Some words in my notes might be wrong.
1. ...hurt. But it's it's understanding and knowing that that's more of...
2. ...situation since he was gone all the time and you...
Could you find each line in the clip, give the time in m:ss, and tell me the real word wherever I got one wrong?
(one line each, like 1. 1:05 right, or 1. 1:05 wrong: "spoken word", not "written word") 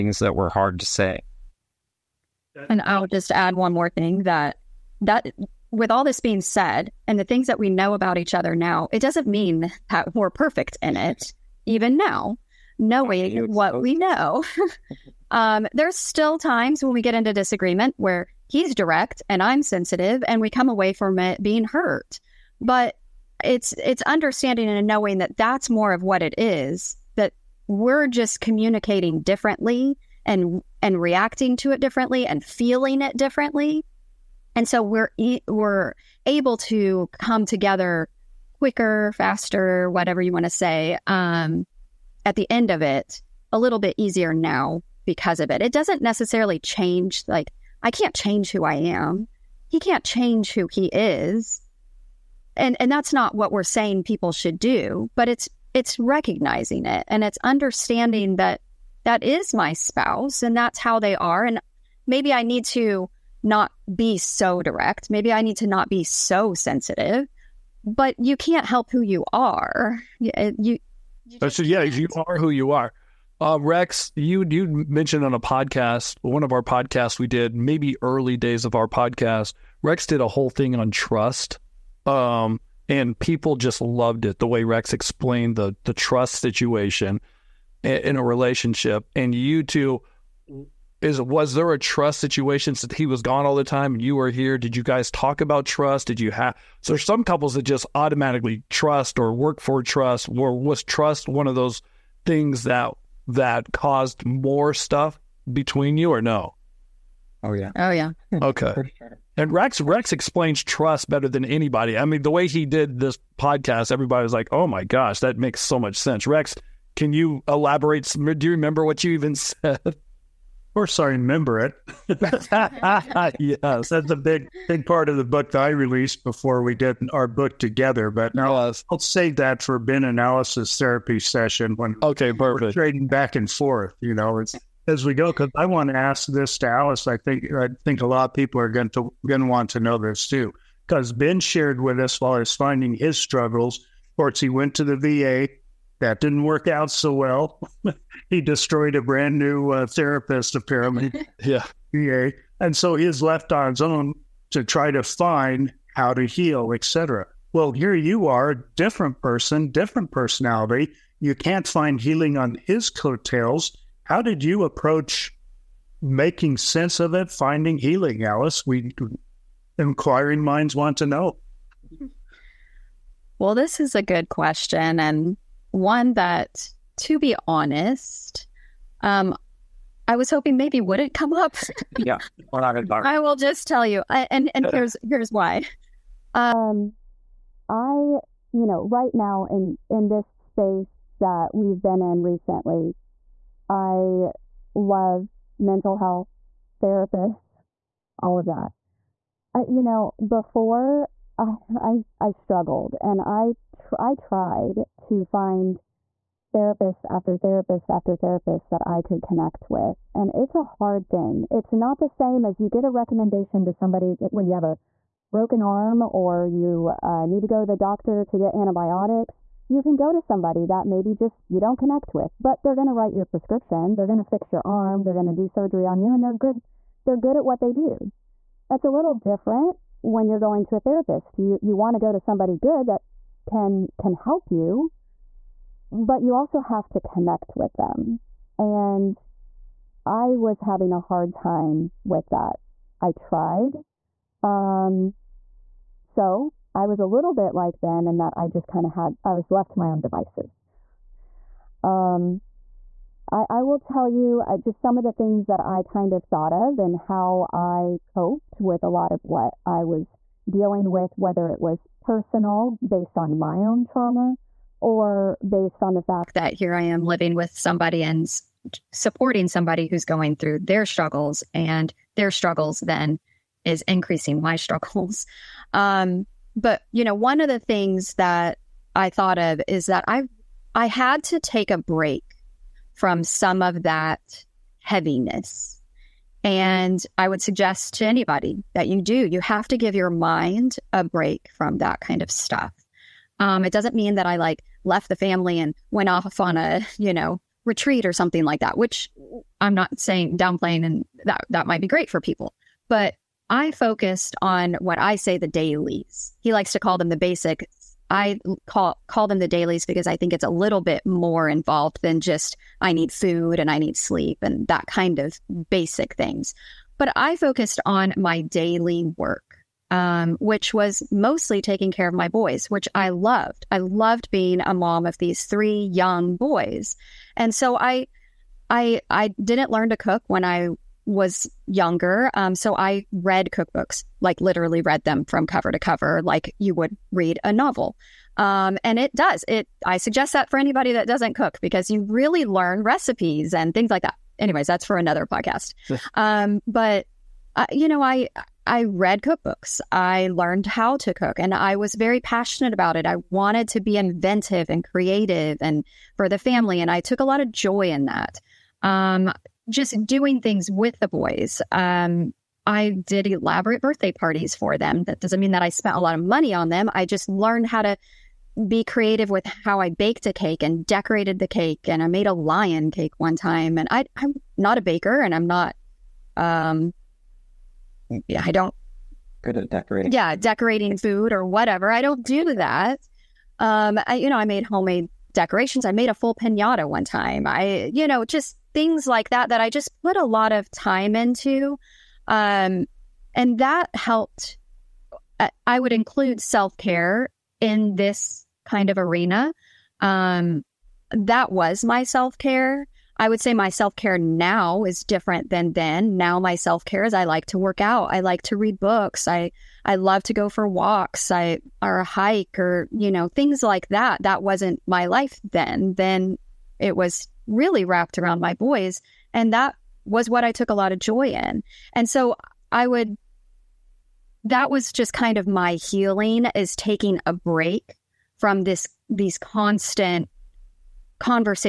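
1. 0:21 right
2. 1:32 right.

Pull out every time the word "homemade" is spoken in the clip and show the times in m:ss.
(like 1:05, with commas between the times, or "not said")
6:24.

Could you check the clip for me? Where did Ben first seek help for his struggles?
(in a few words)
the VA.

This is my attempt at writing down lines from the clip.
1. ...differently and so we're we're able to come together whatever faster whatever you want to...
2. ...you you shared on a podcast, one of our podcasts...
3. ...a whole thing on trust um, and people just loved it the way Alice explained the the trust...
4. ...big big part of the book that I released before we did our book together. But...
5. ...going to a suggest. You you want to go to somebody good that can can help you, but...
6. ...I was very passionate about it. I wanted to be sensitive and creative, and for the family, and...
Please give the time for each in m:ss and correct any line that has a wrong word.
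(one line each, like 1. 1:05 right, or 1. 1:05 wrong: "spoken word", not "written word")
1. 0:33 wrong: "quicker", not "whatever"
2. 1:14 wrong: "mentioned", not "shared"
3. 1:20 wrong: "Rex", not "Alice"
4. 2:04 right
5. 3:50 wrong: "therapist", not "suggest"
6. 5:51 wrong: "inventive", not "sensitive".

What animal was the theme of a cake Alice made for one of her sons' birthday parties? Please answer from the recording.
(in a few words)
lion.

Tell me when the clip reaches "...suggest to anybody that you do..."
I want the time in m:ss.
4:47.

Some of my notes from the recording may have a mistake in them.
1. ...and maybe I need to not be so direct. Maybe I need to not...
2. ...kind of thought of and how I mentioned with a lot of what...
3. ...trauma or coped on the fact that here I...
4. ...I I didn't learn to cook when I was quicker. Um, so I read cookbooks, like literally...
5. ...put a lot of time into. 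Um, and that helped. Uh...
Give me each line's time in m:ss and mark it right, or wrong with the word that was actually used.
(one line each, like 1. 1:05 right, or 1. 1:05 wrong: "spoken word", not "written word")
1. 1:01 right
2. 4:15 wrong: "coped", not "mentioned"
3. 4:23 wrong: "based", not "coped"
4. 5:28 wrong: "younger", not "quicker"
5. 6:30 right.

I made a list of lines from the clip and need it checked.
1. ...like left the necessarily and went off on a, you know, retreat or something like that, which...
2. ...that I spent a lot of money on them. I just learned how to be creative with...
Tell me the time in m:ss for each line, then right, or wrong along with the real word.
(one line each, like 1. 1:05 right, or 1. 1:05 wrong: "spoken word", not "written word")
1. 4:54 wrong: "family", not "necessarily"
2. 6:05 right.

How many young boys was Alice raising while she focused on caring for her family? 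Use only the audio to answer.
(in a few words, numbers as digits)
3.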